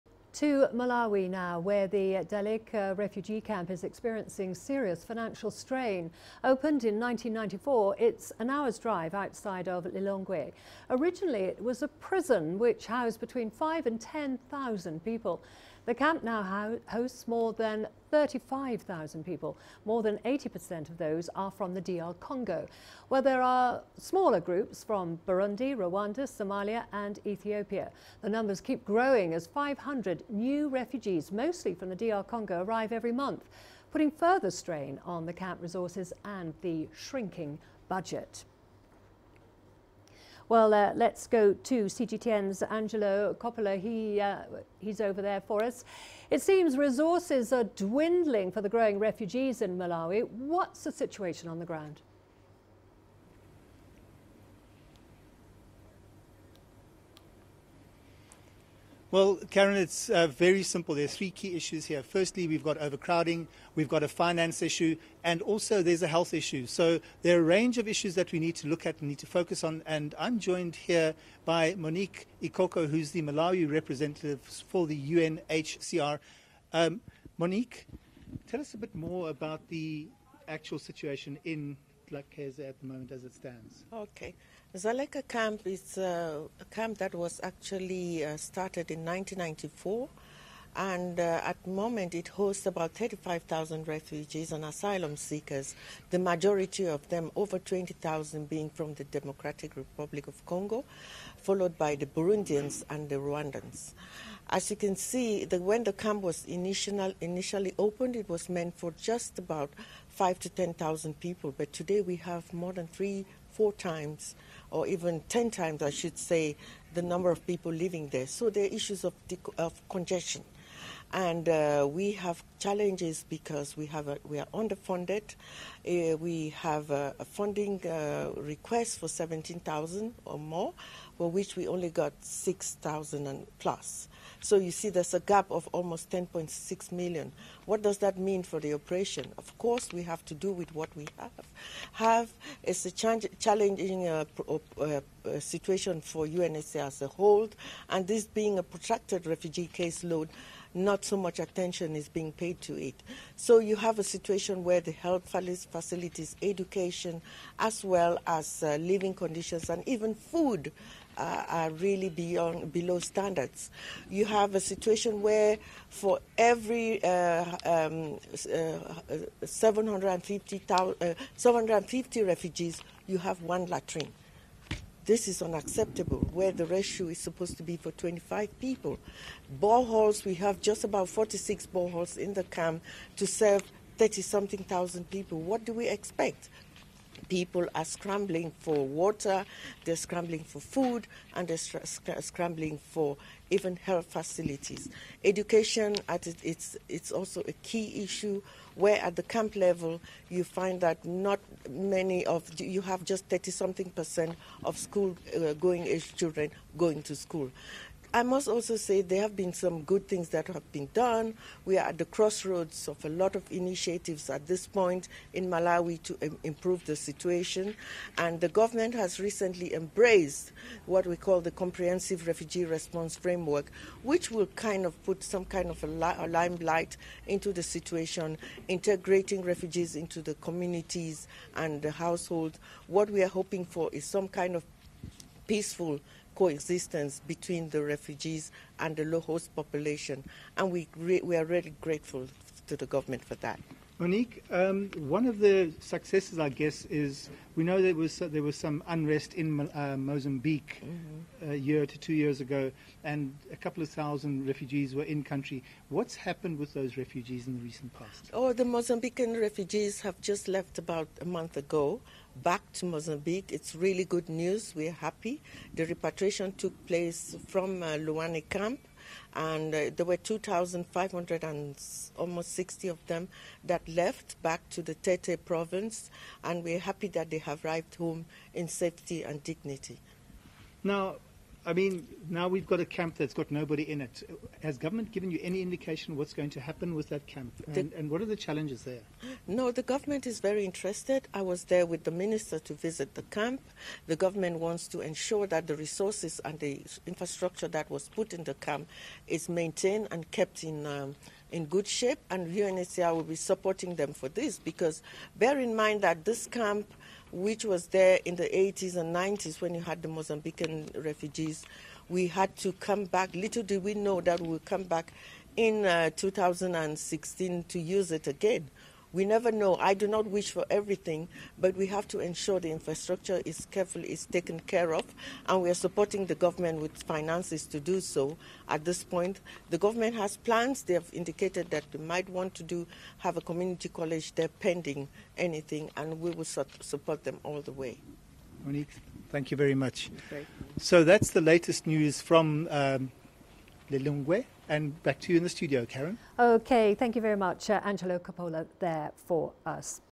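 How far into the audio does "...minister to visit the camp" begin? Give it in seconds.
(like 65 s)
292 s.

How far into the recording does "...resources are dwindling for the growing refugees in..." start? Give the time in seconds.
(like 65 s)
46 s.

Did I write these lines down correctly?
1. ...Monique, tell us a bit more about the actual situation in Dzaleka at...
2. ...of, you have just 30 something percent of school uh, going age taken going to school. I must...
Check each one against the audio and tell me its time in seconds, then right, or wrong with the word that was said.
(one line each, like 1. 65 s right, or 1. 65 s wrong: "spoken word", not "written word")
1. 77 s wrong: "Lakaza", not "Dzaleka"
2. 202 s wrong: "children", not "taken".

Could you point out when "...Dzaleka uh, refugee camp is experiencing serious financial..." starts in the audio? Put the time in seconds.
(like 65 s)
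2 s.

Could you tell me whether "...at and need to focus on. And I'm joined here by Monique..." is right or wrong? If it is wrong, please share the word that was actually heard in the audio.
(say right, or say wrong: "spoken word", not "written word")
right.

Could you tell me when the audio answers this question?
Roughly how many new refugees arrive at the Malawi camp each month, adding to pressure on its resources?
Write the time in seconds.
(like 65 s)
29 s.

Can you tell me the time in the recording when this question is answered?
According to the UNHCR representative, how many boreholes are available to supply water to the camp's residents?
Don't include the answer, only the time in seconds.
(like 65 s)
181 s.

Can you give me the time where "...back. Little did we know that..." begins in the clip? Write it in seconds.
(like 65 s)
313 s.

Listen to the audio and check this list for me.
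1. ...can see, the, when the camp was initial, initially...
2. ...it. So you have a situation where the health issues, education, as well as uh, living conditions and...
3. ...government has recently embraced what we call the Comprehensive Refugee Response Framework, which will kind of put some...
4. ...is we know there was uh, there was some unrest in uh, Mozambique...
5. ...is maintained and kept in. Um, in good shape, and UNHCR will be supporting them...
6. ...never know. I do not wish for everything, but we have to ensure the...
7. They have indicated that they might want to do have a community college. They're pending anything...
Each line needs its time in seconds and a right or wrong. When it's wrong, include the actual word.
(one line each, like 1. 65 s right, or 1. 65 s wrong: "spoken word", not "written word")
1. 104 s right
2. 152 s wrong: "facilities", not "issues"
3. 218 s right
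4. 246 s right
5. 299 s right
6. 319 s right
7. 330 s right.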